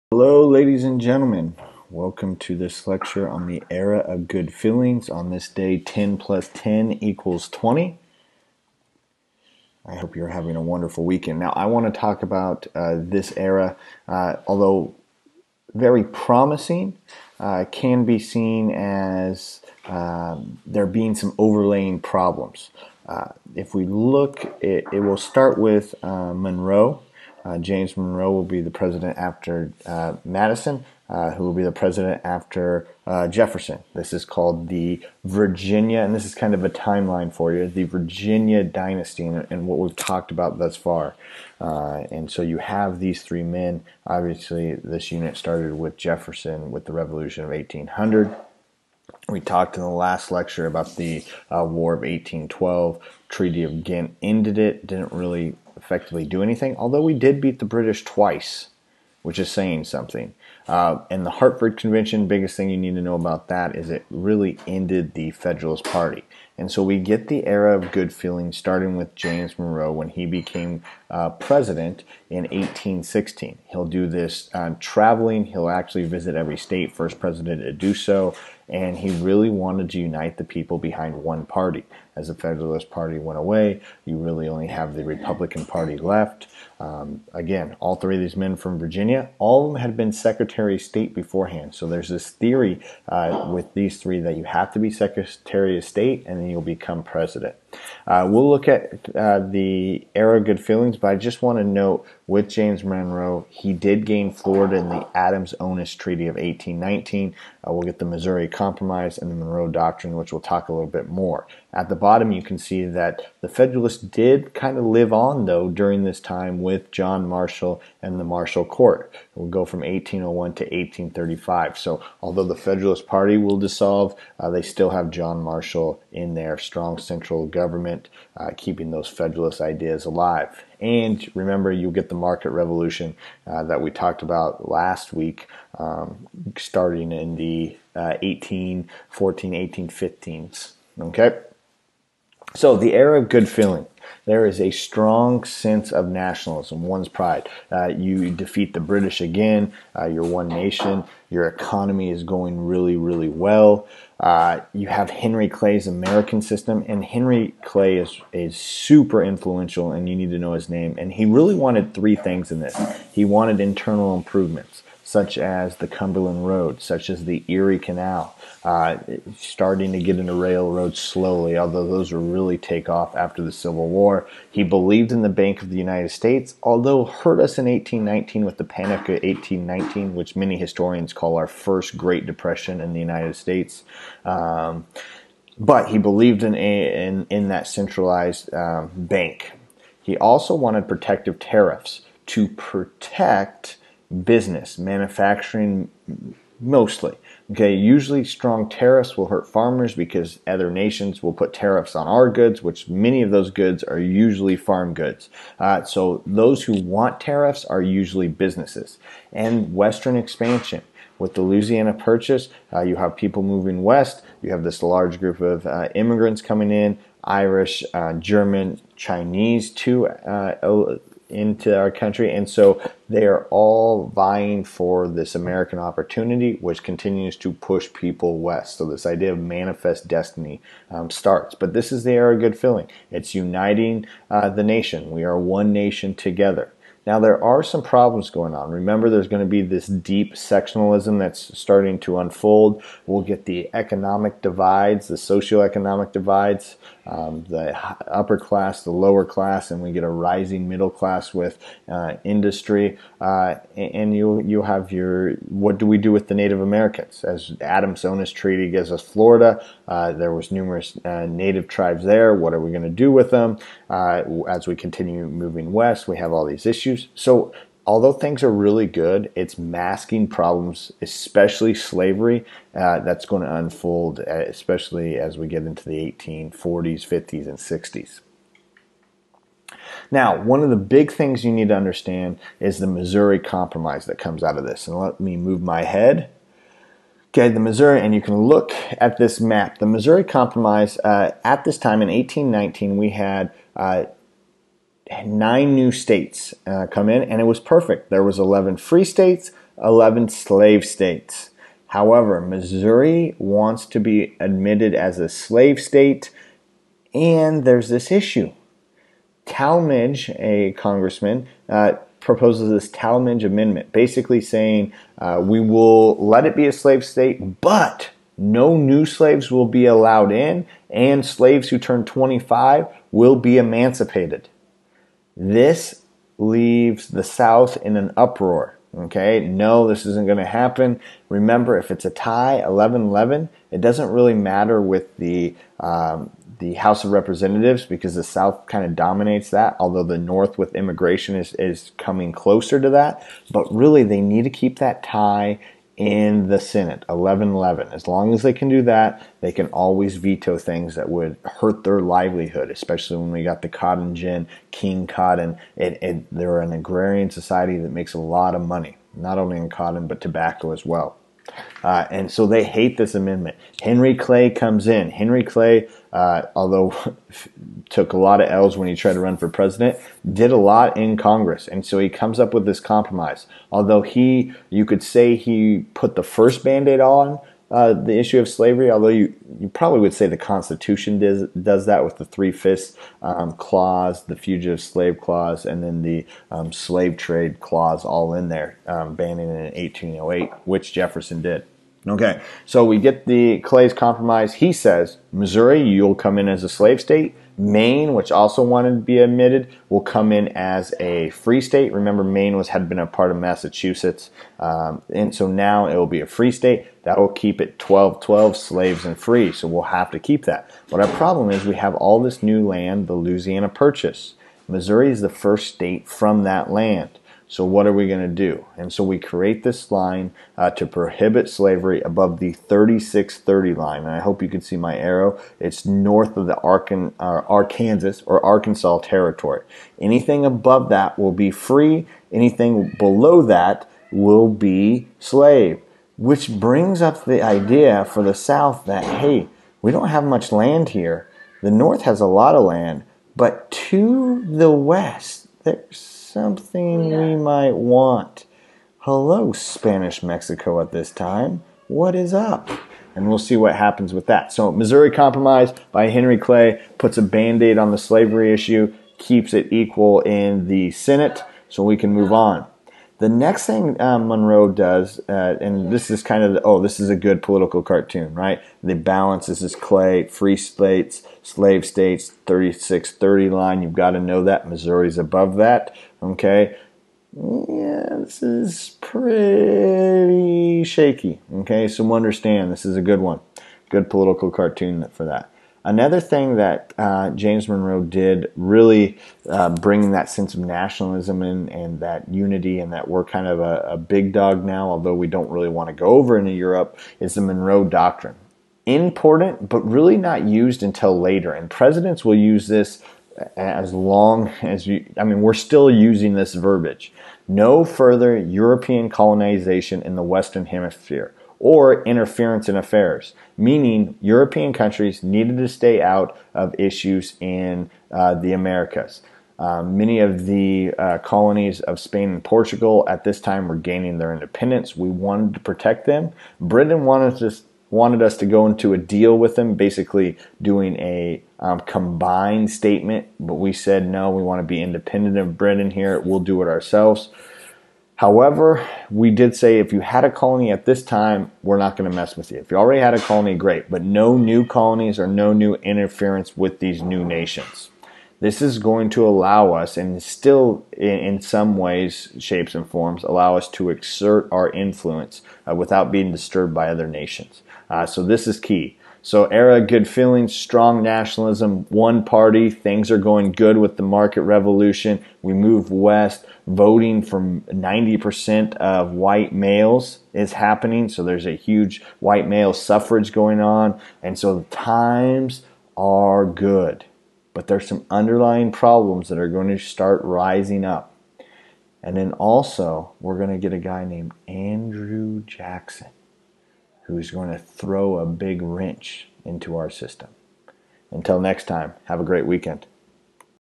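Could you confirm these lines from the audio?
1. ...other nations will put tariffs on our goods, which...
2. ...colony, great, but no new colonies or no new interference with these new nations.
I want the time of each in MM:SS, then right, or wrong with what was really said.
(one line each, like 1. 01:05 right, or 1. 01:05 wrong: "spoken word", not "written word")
1. 03:20 right
2. 09:03 right.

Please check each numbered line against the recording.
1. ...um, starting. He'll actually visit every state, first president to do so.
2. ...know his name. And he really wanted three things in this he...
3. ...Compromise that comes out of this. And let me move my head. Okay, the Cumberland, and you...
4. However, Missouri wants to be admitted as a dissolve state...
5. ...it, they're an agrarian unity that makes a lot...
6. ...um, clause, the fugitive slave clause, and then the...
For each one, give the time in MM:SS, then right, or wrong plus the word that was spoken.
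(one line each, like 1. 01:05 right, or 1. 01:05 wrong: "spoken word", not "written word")
1. 01:14 wrong: "traveling", not "starting"
2. 02:40 right
3. 04:43 wrong: "Missouri", not "Cumberland"
4. 05:01 wrong: "slave", not "dissolve"
5. 05:56 wrong: "society", not "unity"
6. 06:23 right.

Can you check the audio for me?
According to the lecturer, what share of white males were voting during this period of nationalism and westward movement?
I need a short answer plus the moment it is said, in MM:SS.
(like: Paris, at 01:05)
90%, at 09:27.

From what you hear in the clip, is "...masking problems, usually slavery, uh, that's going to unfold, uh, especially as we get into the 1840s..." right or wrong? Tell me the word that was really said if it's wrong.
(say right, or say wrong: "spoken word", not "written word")
wrong: "especially", not "usually".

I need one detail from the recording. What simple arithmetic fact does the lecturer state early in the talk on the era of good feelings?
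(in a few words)
10 plus 10 equals 20.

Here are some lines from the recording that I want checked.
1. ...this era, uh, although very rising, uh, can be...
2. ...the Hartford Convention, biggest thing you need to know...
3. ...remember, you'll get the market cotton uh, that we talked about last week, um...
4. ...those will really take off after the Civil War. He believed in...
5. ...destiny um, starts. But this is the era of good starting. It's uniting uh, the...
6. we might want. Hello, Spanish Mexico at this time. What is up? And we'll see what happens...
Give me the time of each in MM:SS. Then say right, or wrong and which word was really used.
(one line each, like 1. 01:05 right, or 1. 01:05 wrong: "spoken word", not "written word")
1. 00:12 wrong: "promising", not "rising"
2. 01:01 right
3. 02:11 wrong: "revolution", not "cotton"
4. 02:51 right
5. 03:50 wrong: "feeling", not "starting"
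6. 07:27 right.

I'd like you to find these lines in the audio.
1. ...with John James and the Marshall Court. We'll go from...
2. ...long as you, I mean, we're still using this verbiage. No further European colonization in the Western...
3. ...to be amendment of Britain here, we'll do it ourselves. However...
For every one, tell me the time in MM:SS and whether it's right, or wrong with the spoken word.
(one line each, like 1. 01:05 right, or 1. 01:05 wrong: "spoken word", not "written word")
1. 01:56 wrong: "Marshall", not "James"
2. 08:23 right
3. 08:54 wrong: "independent", not "amendment".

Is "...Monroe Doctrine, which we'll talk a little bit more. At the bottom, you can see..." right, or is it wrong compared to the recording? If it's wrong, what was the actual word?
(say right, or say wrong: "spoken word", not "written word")
right.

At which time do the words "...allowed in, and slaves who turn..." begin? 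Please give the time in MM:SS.
05:19.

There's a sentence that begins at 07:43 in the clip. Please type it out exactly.
The next thing um, Monroe does, uh, and this is kind of the, oh, this is a good political cartoon, right?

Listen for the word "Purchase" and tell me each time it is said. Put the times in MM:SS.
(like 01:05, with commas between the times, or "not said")
03:31, 06:53.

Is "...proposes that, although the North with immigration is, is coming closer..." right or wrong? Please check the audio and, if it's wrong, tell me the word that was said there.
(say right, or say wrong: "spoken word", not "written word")
wrong: "dominates", not "proposes".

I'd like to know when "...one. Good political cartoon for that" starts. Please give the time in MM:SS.
08:03.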